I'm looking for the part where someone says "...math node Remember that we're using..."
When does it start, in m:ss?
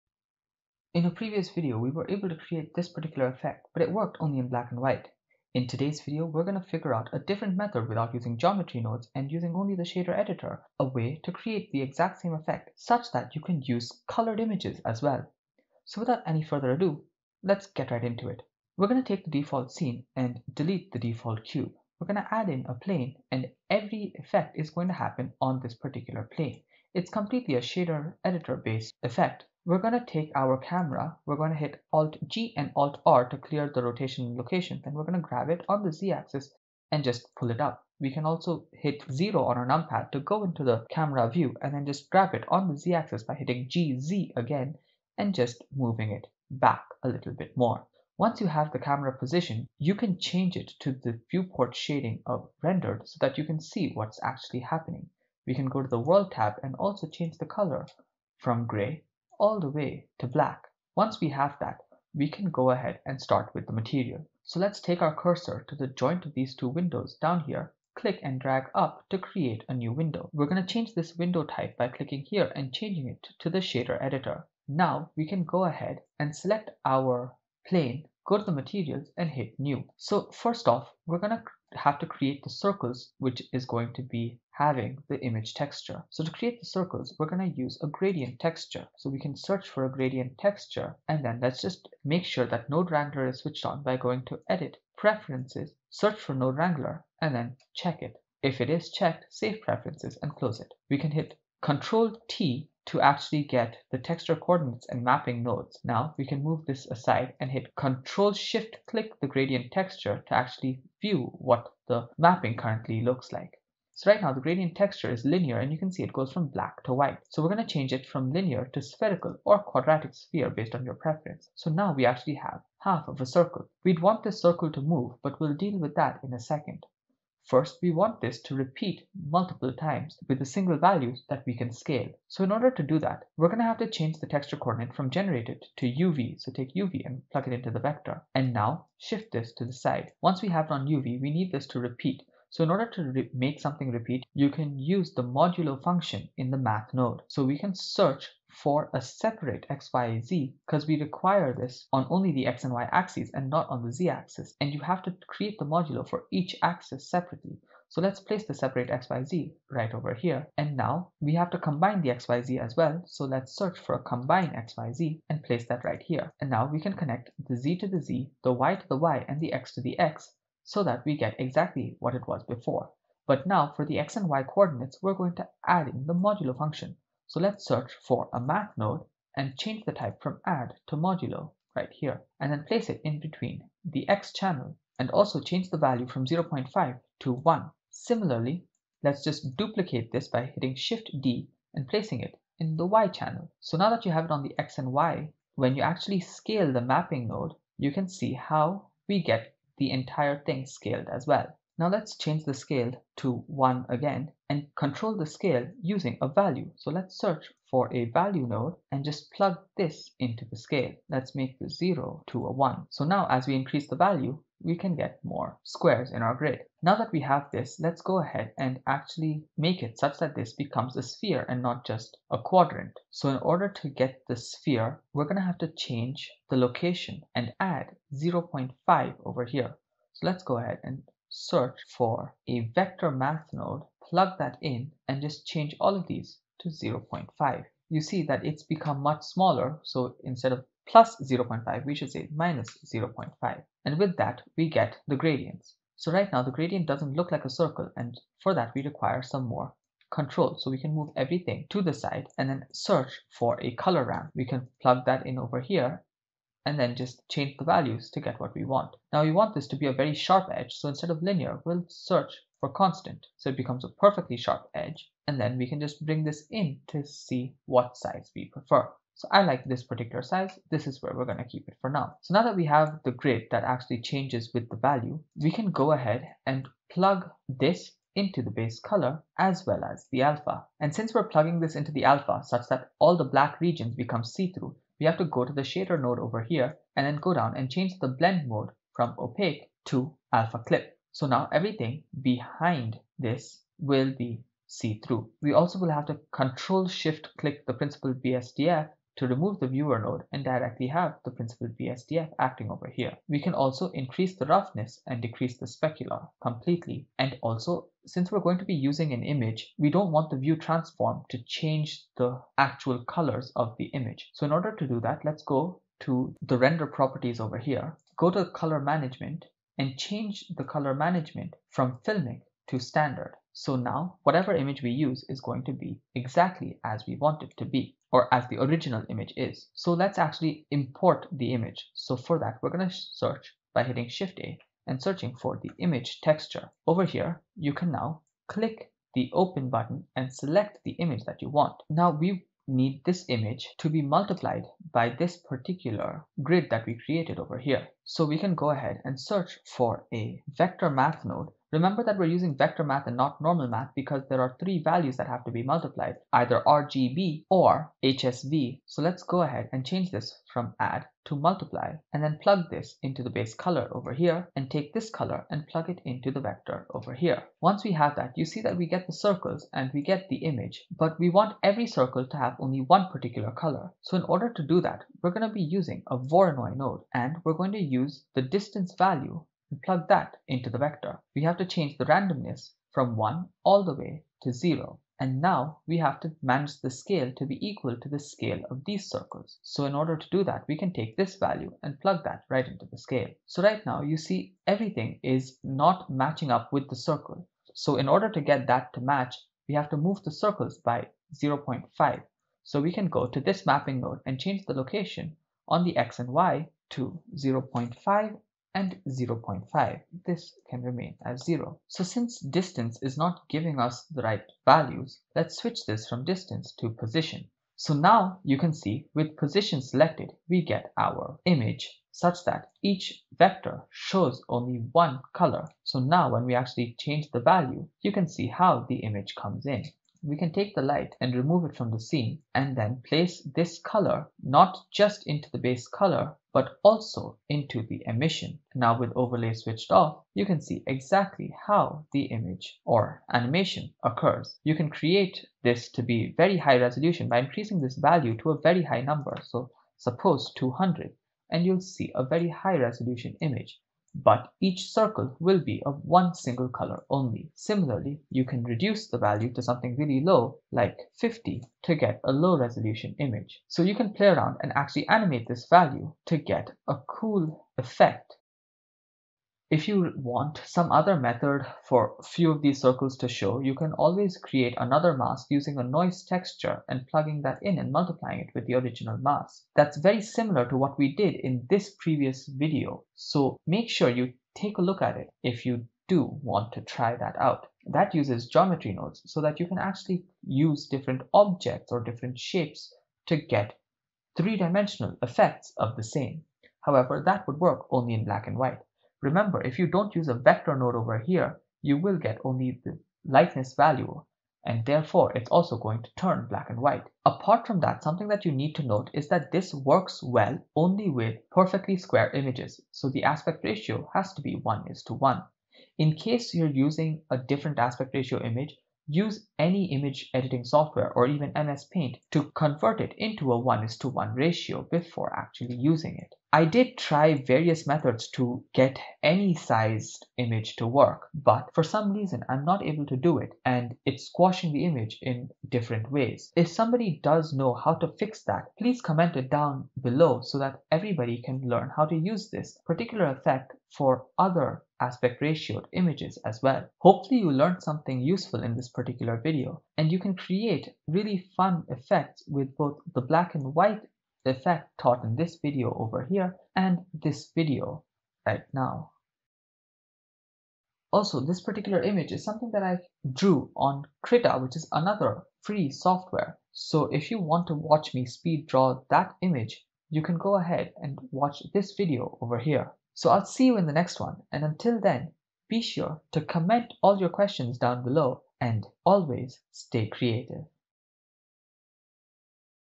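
5:50.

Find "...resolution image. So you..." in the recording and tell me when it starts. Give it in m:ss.
7:42.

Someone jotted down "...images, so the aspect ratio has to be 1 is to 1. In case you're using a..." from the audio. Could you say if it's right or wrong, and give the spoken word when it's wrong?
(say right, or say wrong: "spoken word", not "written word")
right.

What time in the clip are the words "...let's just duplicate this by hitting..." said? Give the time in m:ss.
3:09.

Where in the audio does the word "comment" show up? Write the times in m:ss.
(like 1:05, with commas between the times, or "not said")
8:59, 9:36.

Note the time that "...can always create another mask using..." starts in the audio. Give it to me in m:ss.
7:53.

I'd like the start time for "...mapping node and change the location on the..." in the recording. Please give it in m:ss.
6:43.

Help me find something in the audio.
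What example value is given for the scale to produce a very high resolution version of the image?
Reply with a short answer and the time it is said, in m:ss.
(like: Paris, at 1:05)
200, at 7:30.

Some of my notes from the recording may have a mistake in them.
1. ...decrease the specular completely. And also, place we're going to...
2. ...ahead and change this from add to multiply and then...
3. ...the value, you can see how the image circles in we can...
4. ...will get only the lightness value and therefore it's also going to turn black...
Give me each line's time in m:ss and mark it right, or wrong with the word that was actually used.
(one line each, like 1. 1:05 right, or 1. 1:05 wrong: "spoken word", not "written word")
1. 5:05 wrong: "since", not "place"
2. 5:59 right
3. 7:07 wrong: "comes", not "circles"
4. 8:22 right.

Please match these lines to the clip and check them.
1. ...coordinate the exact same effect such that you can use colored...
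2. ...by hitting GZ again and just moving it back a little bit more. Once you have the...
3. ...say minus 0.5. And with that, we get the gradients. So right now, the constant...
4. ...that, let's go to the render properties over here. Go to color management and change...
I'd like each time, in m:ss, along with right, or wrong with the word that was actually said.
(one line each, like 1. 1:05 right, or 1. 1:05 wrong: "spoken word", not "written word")
1. 0:11 wrong: "create", not "coordinate"
2. 0:43 right
3. 4:02 wrong: "gradient", not "constant"
4. 5:15 right.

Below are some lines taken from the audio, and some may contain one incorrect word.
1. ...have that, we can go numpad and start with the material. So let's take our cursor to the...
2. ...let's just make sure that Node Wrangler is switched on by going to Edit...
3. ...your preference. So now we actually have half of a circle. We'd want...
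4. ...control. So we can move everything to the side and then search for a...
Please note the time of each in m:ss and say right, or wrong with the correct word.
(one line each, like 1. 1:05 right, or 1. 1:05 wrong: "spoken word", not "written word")
1. 1:01 wrong: "ahead", not "numpad"
2. 1:31 right
3. 2:00 right
4. 4:10 right.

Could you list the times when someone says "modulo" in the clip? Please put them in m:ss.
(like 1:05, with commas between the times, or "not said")
2:25, 2:35, 2:56, 3:00.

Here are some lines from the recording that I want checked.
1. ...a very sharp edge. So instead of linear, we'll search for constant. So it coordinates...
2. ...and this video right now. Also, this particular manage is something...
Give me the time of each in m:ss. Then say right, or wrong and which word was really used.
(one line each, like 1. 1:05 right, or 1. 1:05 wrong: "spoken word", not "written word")
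1. 4:19 wrong: "becomes", not "coordinates"
2. 9:16 wrong: "image", not "manage".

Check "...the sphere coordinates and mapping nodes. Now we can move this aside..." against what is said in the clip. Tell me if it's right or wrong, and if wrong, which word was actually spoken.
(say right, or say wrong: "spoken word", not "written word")
wrong: "texture", not "sphere".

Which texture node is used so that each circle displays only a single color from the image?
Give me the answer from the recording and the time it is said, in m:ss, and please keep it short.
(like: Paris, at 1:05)
Voronoi, at 6:16.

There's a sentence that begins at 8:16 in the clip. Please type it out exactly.
However, that would work only in black and white.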